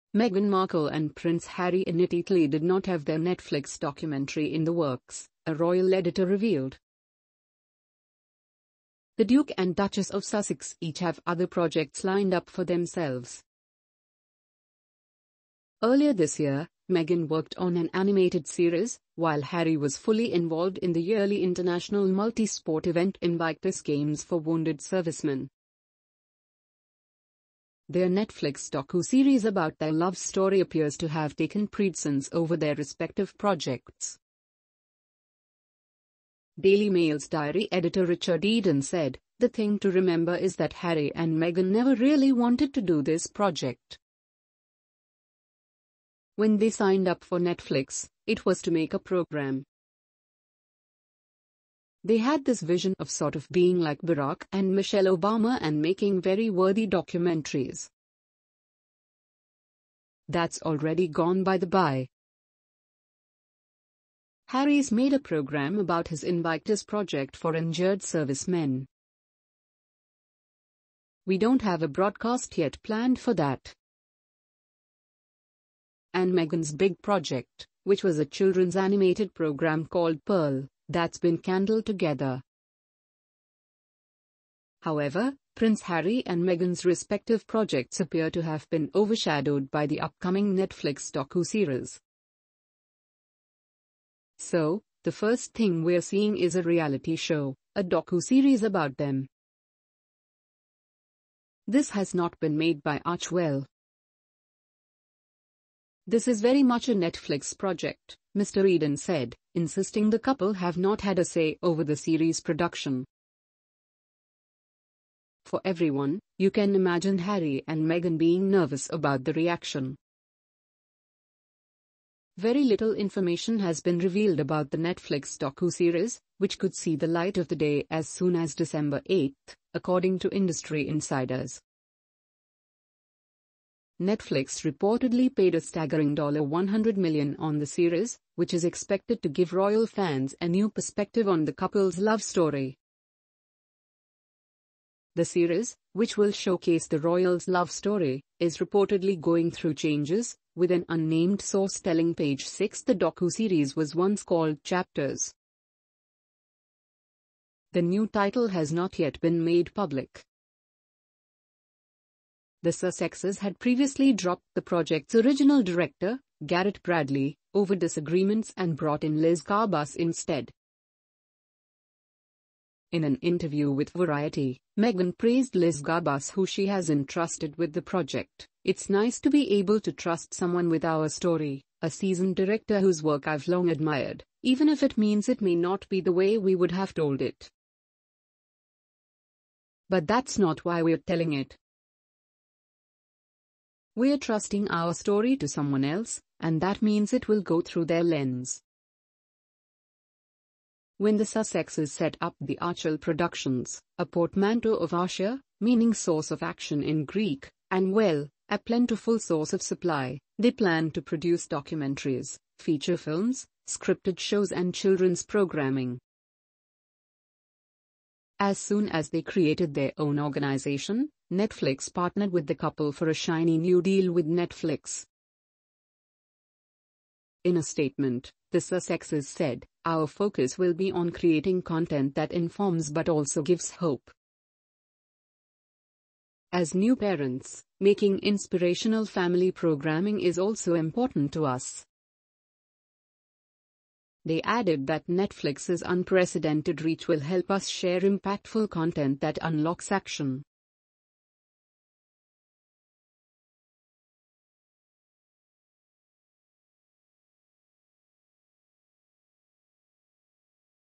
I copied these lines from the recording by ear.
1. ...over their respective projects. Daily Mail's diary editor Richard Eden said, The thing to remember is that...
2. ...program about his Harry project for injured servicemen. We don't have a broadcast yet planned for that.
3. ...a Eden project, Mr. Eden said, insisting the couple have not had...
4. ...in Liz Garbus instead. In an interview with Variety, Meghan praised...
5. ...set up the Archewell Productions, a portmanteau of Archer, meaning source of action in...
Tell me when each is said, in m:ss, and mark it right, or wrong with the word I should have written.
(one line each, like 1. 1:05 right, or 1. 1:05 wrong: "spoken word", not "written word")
1. 0:32 right
2. 1:05 wrong: "Invictus", not "Harry"
3. 1:46 wrong: "Netflix", not "Eden"
4. 2:49 right
5. 3:21 right.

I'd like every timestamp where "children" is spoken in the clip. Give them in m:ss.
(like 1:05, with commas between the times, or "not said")
1:18, 3:34.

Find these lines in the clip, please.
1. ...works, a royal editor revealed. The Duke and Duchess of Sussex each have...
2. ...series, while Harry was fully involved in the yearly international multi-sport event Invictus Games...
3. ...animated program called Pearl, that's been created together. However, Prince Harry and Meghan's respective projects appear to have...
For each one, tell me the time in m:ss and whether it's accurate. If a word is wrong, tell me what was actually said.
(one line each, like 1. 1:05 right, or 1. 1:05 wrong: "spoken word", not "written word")
1. 0:04 right
2. 0:18 right
3. 1:18 wrong: "candled", not "created".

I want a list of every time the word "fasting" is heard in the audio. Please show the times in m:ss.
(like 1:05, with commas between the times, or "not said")
not said.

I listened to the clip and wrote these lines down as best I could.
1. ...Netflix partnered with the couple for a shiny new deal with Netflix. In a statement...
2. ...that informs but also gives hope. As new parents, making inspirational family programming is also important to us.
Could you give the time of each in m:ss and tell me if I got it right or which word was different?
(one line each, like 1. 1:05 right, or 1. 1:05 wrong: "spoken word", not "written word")
1. 3:41 right
2. 3:52 right.